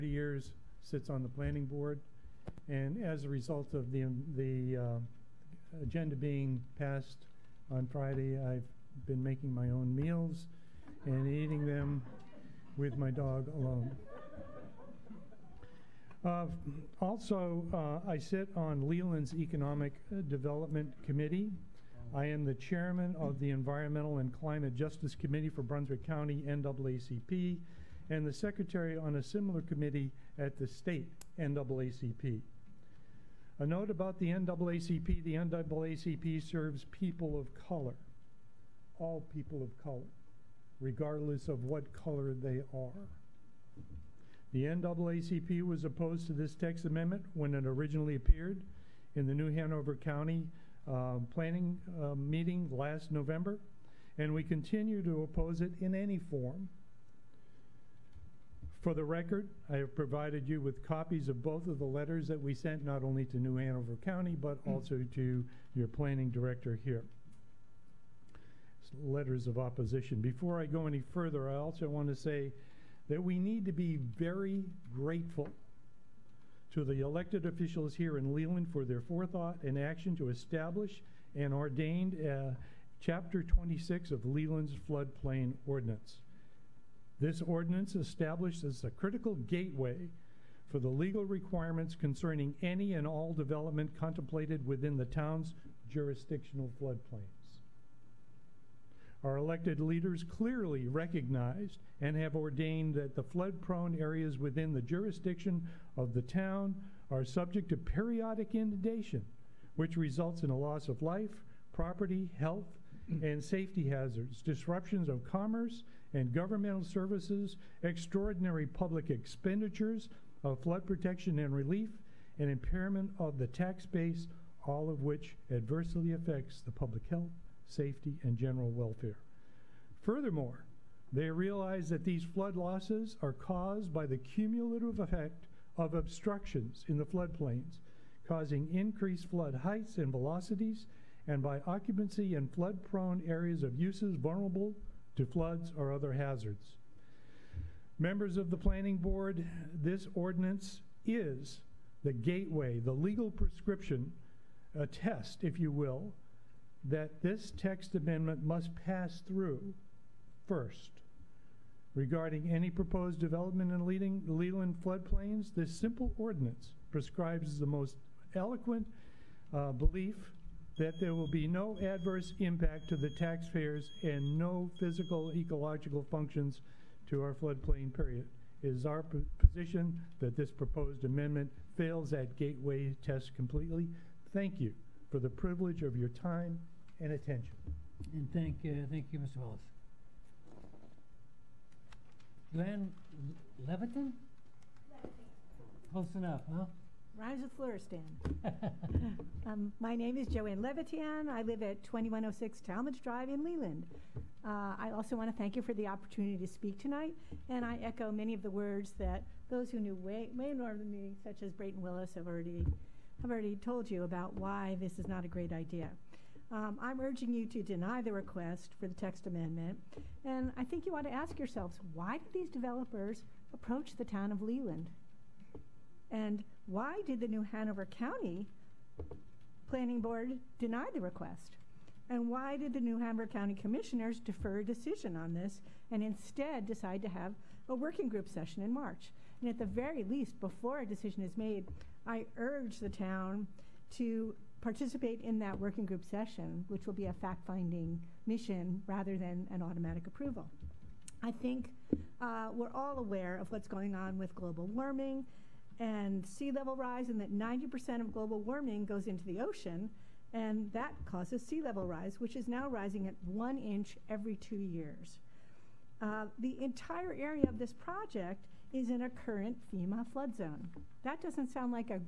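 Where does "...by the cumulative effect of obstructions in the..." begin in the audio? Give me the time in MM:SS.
02:13.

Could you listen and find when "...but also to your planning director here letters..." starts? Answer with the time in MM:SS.
01:04.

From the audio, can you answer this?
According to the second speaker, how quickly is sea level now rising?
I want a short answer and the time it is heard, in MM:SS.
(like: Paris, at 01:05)
1 inch every 2 years, at 04:23.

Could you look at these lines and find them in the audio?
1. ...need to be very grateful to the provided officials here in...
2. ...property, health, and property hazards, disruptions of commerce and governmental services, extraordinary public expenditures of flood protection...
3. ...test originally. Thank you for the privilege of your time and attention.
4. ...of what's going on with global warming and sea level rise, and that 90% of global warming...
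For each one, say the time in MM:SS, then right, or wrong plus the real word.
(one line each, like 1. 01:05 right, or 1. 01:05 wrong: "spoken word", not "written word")
1. 01:13 wrong: "elected", not "provided"
2. 01:51 wrong: "safety", not "property"
3. 03:03 wrong: "completely", not "originally"
4. 04:13 right.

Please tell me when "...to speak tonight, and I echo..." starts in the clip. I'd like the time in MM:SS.
03:26.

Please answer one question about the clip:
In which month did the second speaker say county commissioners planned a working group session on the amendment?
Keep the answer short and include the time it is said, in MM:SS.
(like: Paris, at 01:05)
March, at 03:58.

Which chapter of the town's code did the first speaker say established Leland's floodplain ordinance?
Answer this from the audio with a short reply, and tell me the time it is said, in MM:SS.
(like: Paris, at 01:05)
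Chapter 26, at 01:22.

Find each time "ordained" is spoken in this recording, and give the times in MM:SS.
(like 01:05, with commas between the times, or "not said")
01:21, 01:42.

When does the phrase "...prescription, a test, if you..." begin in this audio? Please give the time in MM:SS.
02:33.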